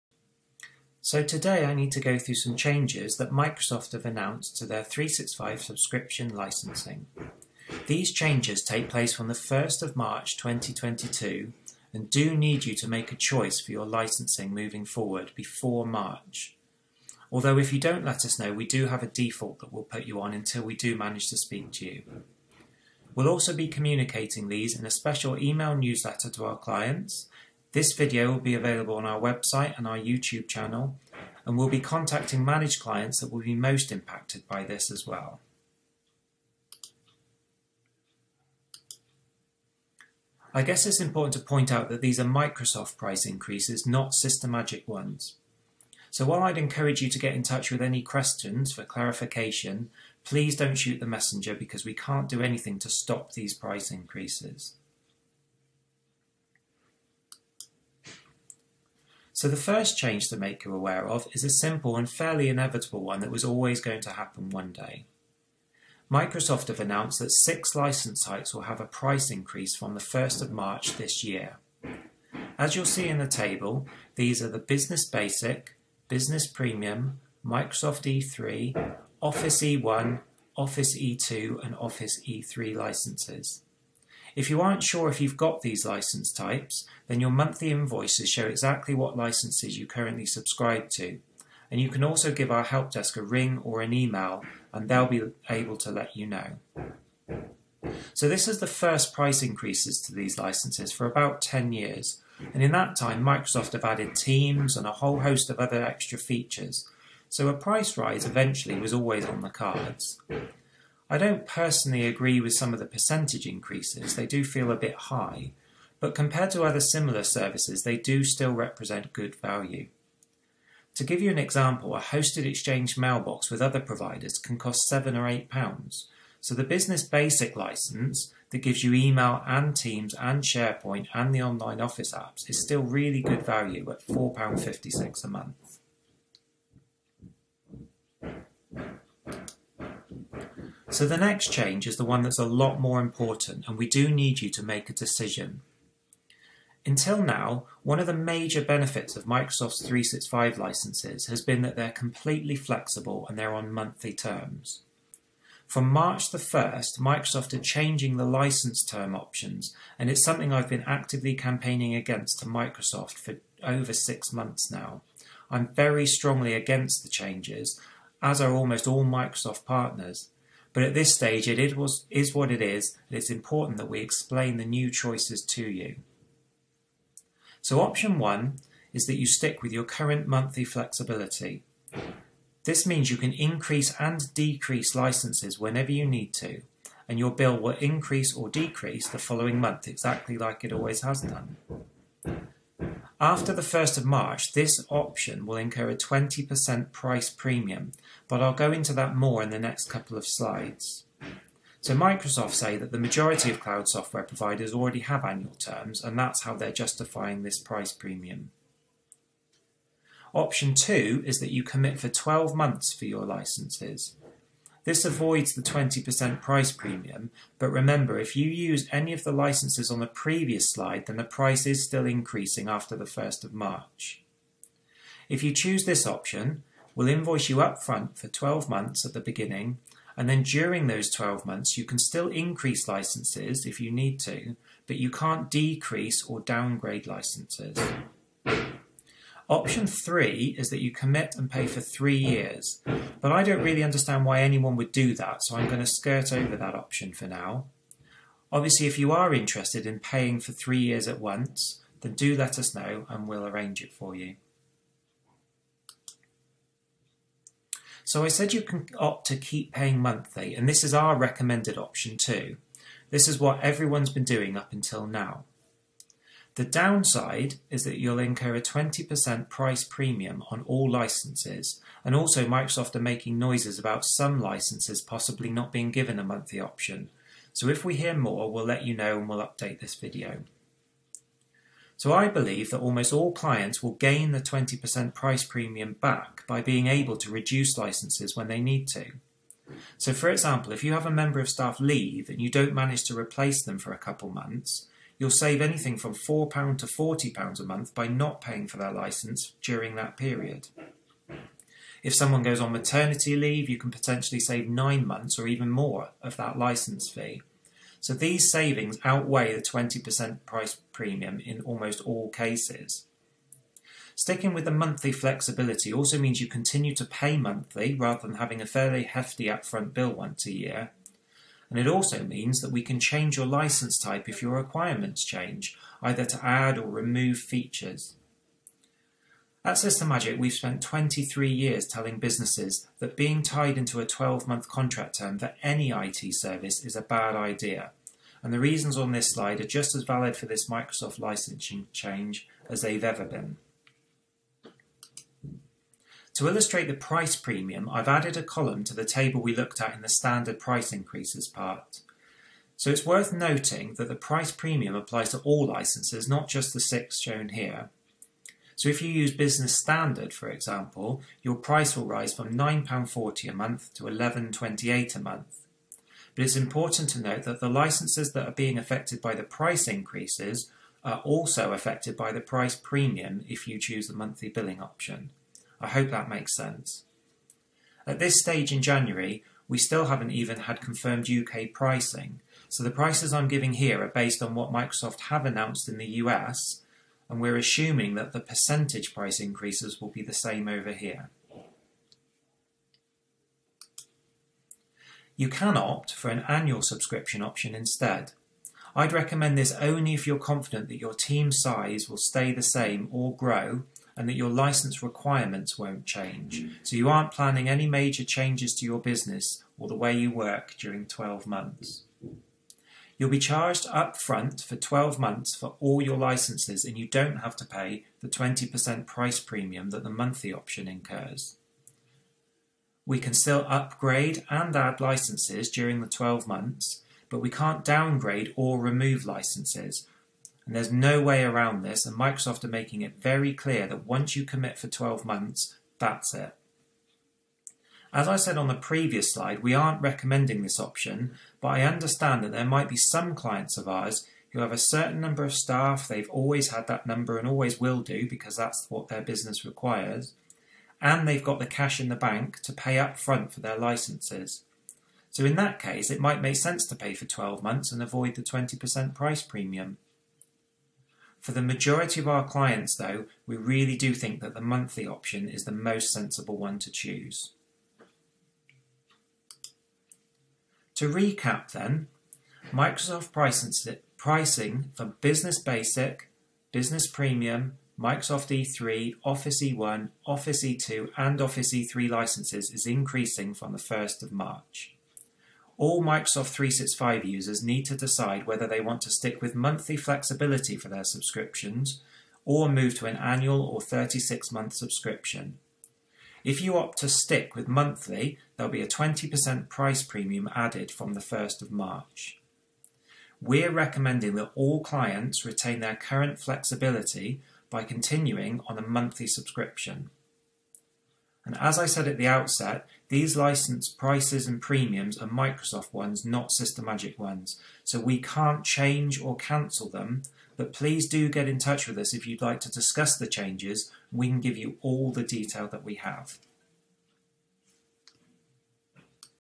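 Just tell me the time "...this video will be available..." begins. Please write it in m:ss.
0:27.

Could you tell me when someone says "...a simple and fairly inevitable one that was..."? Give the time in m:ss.
1:01.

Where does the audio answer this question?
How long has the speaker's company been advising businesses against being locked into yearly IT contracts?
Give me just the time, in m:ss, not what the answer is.
5:30.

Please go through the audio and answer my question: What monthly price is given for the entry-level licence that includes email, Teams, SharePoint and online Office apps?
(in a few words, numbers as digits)
£4.56.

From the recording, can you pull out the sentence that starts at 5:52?
So it's worth noting that the price premium applies to all licenses, not just the six shown here.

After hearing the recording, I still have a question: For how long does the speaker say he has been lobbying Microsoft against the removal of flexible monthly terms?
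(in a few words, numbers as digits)
Over six months.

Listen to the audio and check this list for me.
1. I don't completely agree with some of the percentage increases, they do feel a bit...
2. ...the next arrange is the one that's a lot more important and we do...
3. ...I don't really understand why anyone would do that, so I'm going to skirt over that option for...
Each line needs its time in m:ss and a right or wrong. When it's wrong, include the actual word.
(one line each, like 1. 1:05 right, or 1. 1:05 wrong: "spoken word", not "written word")
1. 1:51 wrong: "personally", not "completely"
2. 2:21 wrong: "change", not "arrange"
3. 4:03 right.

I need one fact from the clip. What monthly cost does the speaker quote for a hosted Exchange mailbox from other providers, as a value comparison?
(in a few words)
7 or 8 pounds.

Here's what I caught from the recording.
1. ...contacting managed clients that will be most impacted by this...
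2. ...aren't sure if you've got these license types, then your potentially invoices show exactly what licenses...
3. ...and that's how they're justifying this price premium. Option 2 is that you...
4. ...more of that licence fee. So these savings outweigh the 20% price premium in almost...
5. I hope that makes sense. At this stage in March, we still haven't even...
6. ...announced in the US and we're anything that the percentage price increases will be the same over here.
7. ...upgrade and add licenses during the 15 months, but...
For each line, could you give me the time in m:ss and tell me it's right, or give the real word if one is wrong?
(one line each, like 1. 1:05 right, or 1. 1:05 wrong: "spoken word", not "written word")
1. 0:31 right
2. 1:24 wrong: "monthly", not "potentially"
3. 3:26 right
4. 5:05 right
5. 6:15 wrong: "January", not "March"
6. 6:25 wrong: "assuming", not "anything"
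7. 7:03 wrong: "12", not "15".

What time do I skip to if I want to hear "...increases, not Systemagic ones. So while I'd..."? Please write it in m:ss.
0:43.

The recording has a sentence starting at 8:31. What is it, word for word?
And as I said at the outset, these license prices and premiums are Microsoft ones, not Systemagic ones.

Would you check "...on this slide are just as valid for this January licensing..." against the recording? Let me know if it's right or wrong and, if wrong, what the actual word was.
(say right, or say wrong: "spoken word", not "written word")
wrong: "Microsoft", not "January".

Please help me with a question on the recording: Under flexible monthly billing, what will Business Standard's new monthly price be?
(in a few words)
£11.28.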